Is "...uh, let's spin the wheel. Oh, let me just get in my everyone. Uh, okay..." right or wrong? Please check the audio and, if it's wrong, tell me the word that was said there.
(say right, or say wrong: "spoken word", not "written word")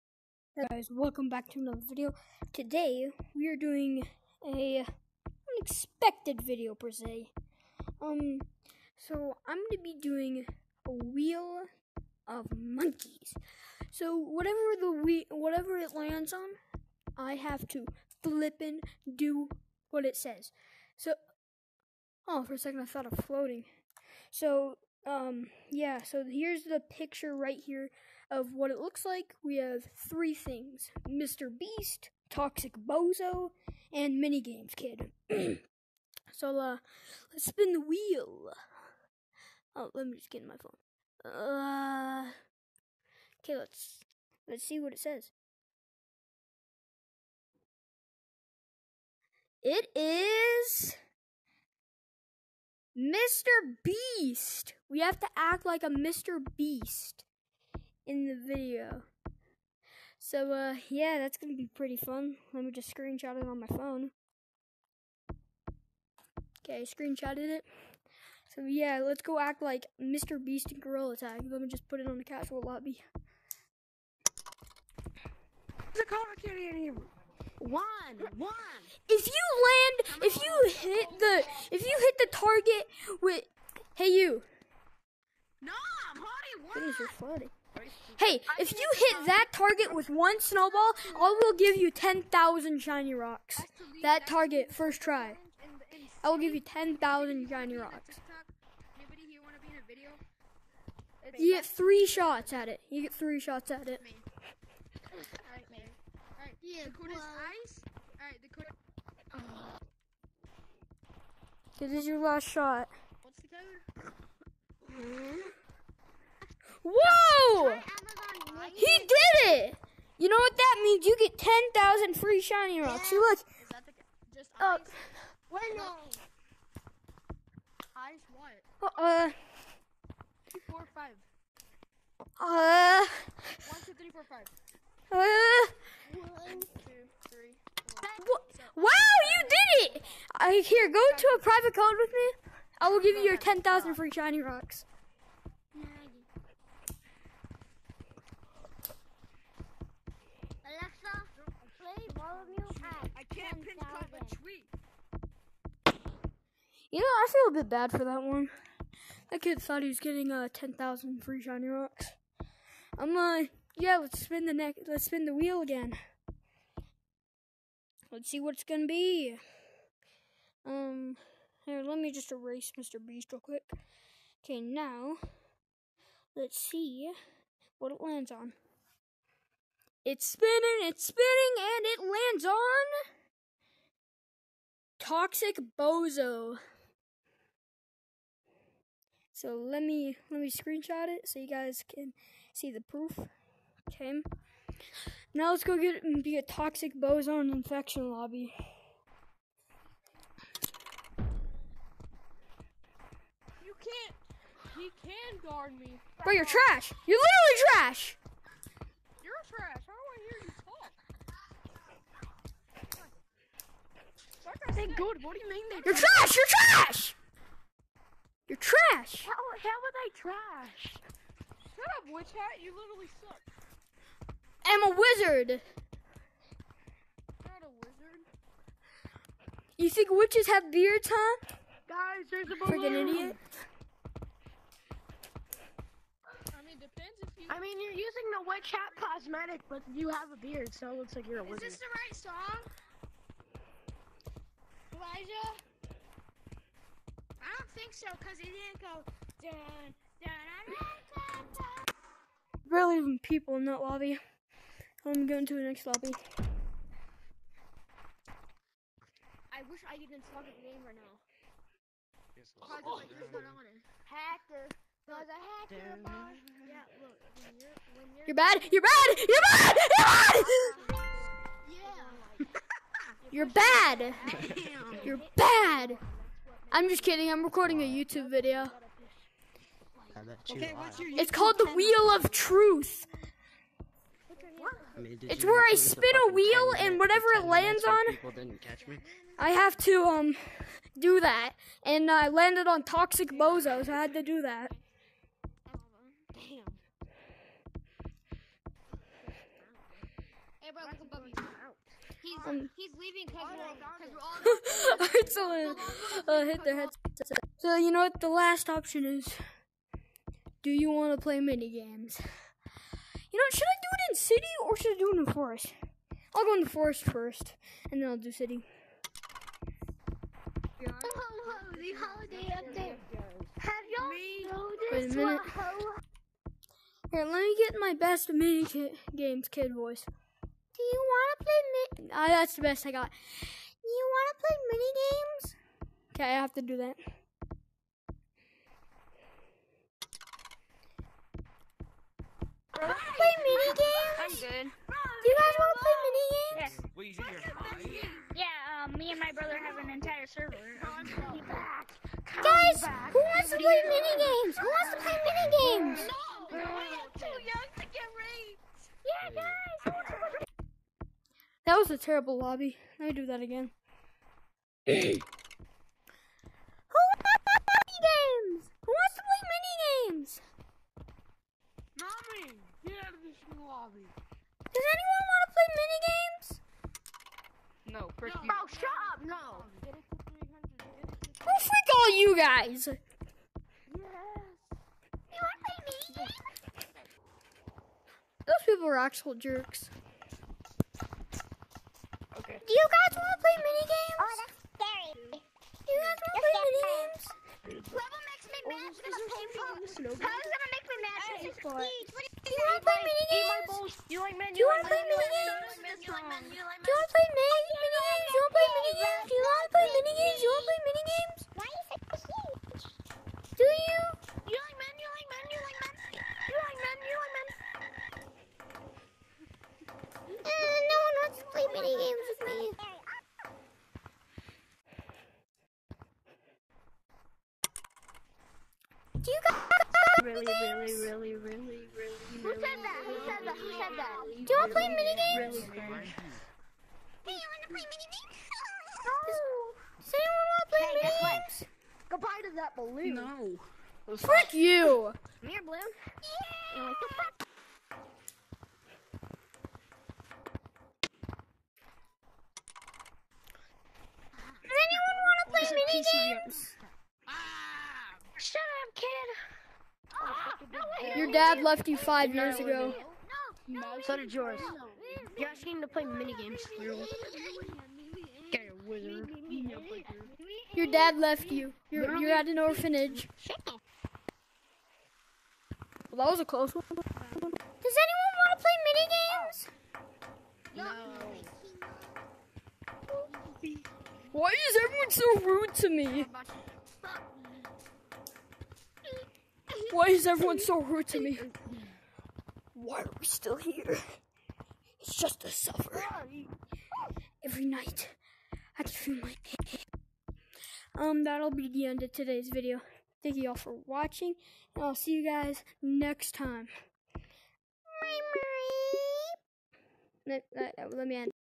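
wrong: "phone", not "everyone".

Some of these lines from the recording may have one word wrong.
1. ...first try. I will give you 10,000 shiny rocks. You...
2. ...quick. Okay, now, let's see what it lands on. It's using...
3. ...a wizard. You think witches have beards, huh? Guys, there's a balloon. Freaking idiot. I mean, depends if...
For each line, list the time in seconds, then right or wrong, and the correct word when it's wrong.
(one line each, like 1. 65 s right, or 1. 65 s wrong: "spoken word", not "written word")
1. 94 s right
2. 173 s wrong: "spinning", not "using"
3. 227 s right.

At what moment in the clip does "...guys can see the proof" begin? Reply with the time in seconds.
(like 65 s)
191 s.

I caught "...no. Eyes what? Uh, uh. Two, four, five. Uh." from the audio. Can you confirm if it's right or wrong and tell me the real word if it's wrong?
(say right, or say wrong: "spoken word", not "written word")
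right.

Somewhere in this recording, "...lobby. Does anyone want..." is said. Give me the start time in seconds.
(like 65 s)
373 s.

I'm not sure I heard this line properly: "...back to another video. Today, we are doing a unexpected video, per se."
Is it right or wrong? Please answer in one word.
right.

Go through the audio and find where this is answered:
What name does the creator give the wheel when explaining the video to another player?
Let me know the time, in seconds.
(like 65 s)
281 s.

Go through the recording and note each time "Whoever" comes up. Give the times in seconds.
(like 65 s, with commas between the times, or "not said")
397 s.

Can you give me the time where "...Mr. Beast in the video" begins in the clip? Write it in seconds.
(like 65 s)
55 s.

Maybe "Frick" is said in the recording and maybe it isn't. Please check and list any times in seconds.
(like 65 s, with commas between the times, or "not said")
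378 s, 444 s.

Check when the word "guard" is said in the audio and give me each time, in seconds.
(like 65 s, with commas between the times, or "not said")
205 s.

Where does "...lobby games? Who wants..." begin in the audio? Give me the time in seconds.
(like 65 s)
367 s.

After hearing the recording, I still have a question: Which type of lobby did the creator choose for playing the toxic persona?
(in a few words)
Infection.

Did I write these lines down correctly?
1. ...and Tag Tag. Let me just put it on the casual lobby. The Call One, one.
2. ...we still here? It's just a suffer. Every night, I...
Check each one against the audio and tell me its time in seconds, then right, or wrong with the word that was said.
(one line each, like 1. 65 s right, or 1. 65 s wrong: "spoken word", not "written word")
1. 70 s wrong: "Gorilla", not "Tag"
2. 493 s right.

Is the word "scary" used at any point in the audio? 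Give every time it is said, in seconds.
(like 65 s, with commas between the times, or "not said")
394 s.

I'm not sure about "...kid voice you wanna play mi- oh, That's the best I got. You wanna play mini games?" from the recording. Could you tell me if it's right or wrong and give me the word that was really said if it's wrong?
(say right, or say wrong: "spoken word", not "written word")
right.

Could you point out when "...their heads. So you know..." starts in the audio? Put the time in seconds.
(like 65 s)
306 s.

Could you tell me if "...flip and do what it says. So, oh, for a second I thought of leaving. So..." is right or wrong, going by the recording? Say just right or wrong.
wrong.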